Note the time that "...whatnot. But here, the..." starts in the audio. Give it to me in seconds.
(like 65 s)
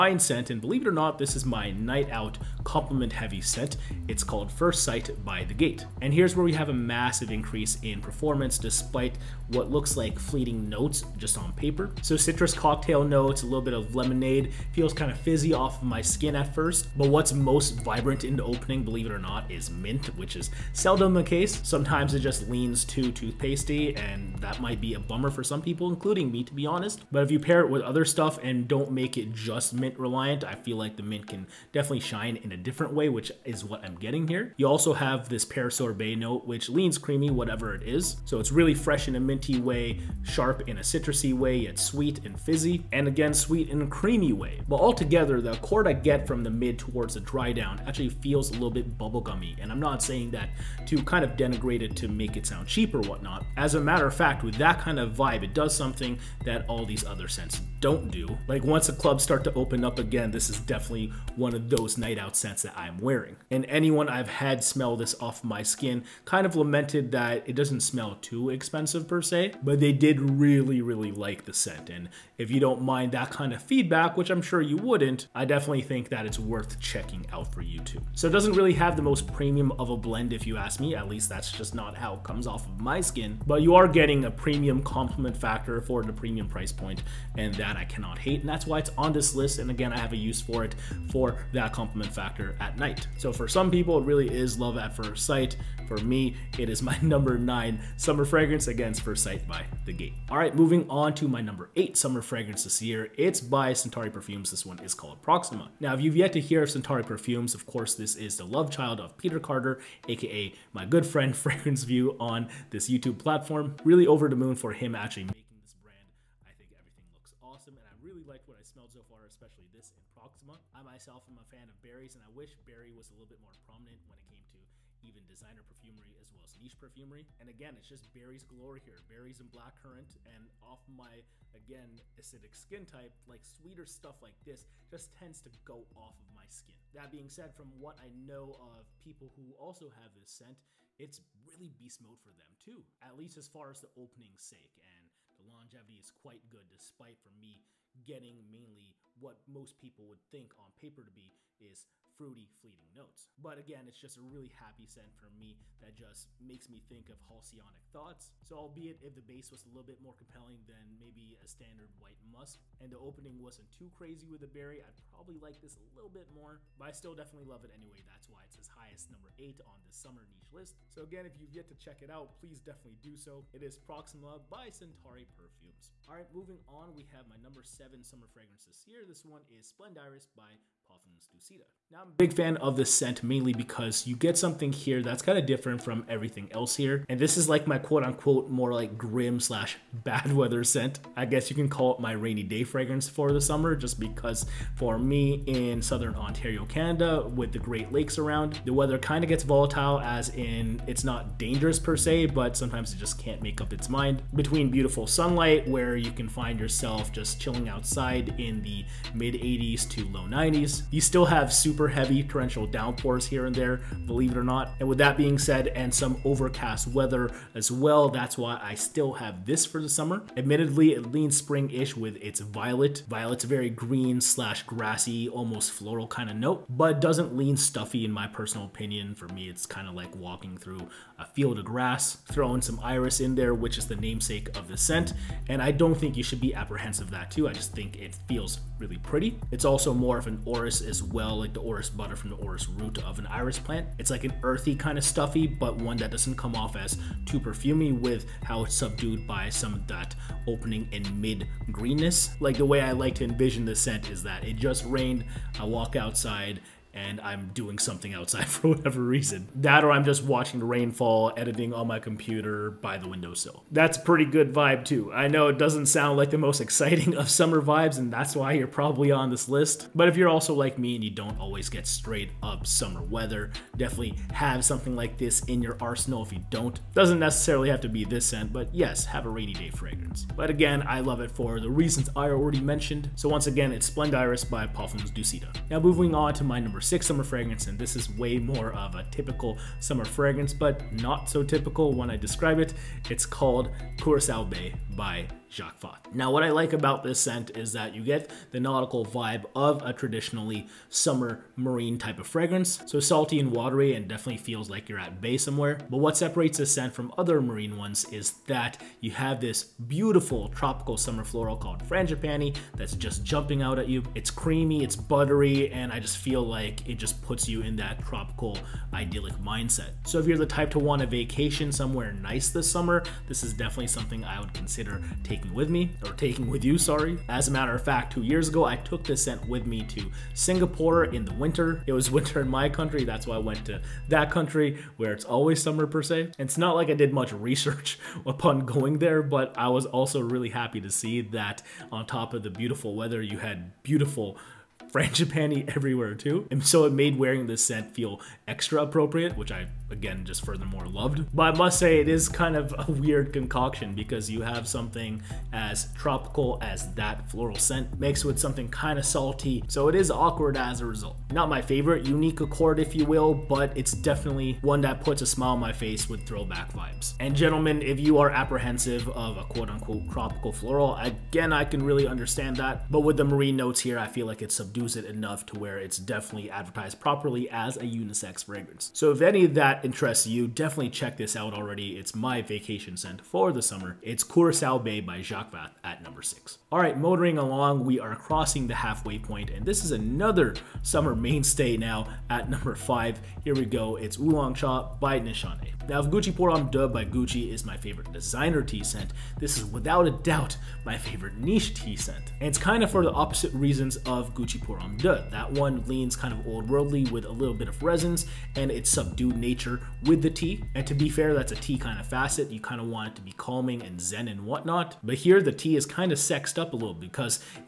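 414 s.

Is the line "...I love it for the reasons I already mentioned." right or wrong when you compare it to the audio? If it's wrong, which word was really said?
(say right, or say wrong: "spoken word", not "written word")
right.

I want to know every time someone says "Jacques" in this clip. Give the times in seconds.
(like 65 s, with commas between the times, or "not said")
295 s, 385 s.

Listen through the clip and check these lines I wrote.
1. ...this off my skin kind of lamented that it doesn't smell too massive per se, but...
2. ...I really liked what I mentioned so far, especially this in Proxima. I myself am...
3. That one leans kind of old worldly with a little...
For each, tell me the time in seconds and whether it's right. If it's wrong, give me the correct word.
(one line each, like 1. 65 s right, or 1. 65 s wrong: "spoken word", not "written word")
1. 64 s wrong: "expensive", not "massive"
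2. 117 s wrong: "smelled", not "mentioned"
3. 405 s right.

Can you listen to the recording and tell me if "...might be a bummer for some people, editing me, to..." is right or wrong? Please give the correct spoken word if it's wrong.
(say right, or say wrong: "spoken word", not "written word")
wrong: "including", not "editing".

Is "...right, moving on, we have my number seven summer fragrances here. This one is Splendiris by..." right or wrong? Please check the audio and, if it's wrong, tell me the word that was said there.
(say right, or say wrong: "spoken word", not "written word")
right.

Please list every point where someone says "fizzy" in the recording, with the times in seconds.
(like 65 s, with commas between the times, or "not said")
15 s, 42 s.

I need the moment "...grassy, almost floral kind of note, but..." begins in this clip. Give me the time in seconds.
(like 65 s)
224 s.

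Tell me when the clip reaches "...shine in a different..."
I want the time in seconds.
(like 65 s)
31 s.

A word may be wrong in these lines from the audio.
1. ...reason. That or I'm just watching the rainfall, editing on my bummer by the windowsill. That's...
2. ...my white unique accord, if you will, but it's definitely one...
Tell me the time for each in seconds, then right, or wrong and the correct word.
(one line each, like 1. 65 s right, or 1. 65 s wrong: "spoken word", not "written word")
1. 259 s wrong: "computer", not "bummer"
2. 361 s wrong: "favorite", not "white".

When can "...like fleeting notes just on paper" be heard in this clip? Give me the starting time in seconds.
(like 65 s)
9 s.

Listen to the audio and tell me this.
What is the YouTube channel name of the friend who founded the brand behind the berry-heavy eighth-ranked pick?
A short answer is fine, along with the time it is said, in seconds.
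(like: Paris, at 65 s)
Fragrance View, at 111 s.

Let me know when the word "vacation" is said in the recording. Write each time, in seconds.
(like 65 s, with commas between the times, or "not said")
321 s, 382 s.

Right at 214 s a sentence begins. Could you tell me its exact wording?
And with that being said, and some overcast weather as well, that's why I still have this for the summer.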